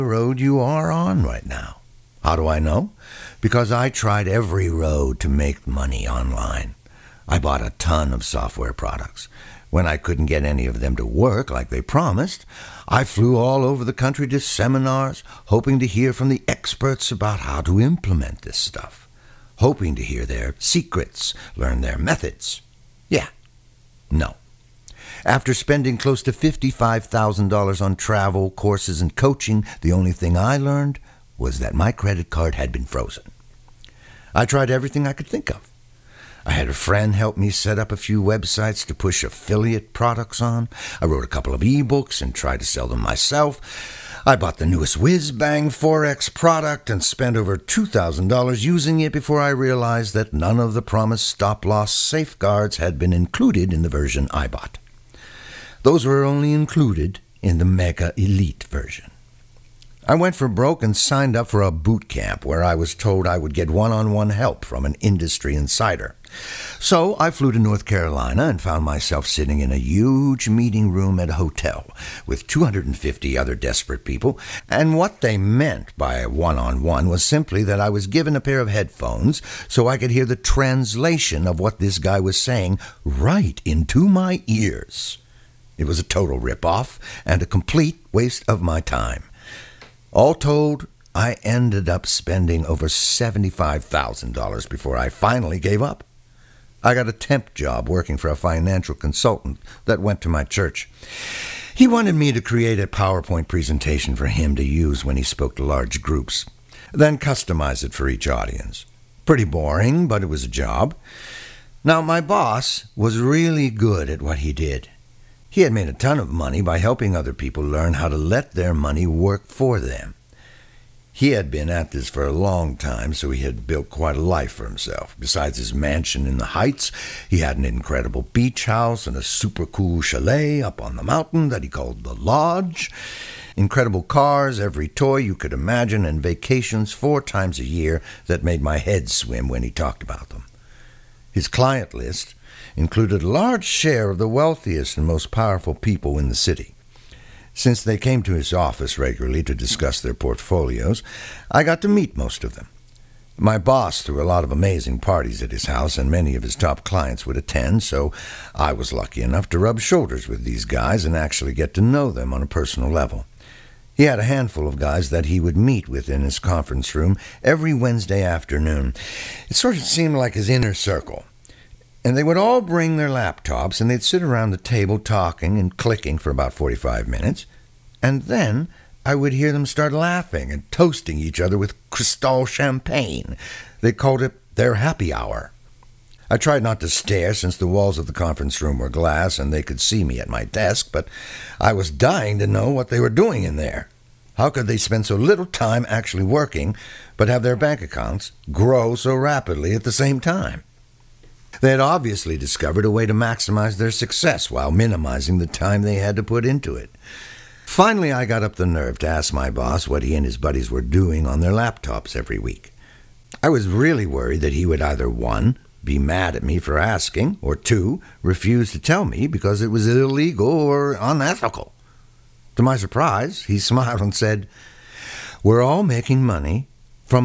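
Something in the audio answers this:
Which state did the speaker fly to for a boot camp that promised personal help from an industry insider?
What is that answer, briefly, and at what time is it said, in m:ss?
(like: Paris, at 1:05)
North Carolina, at 1:07.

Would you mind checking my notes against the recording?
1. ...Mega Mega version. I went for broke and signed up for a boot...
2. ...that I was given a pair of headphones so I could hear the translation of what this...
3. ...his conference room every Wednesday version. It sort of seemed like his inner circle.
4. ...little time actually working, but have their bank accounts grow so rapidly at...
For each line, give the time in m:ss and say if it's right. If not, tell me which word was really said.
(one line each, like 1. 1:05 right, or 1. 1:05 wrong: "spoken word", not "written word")
1. 0:57 wrong: "Elite", not "Mega"
2. 1:17 right
3. 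2:46 wrong: "afternoon", not "version"
4. 3:15 right.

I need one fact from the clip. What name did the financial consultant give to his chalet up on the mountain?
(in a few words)
the Lodge.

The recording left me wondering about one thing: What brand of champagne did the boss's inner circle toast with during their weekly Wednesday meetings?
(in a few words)
Cristal.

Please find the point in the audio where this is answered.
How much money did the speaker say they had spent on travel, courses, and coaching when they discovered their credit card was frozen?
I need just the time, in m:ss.
0:26.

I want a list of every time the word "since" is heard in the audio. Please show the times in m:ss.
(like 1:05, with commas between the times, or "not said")
2:27, 3:07.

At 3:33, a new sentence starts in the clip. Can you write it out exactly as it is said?
I was really worried that he would either 1.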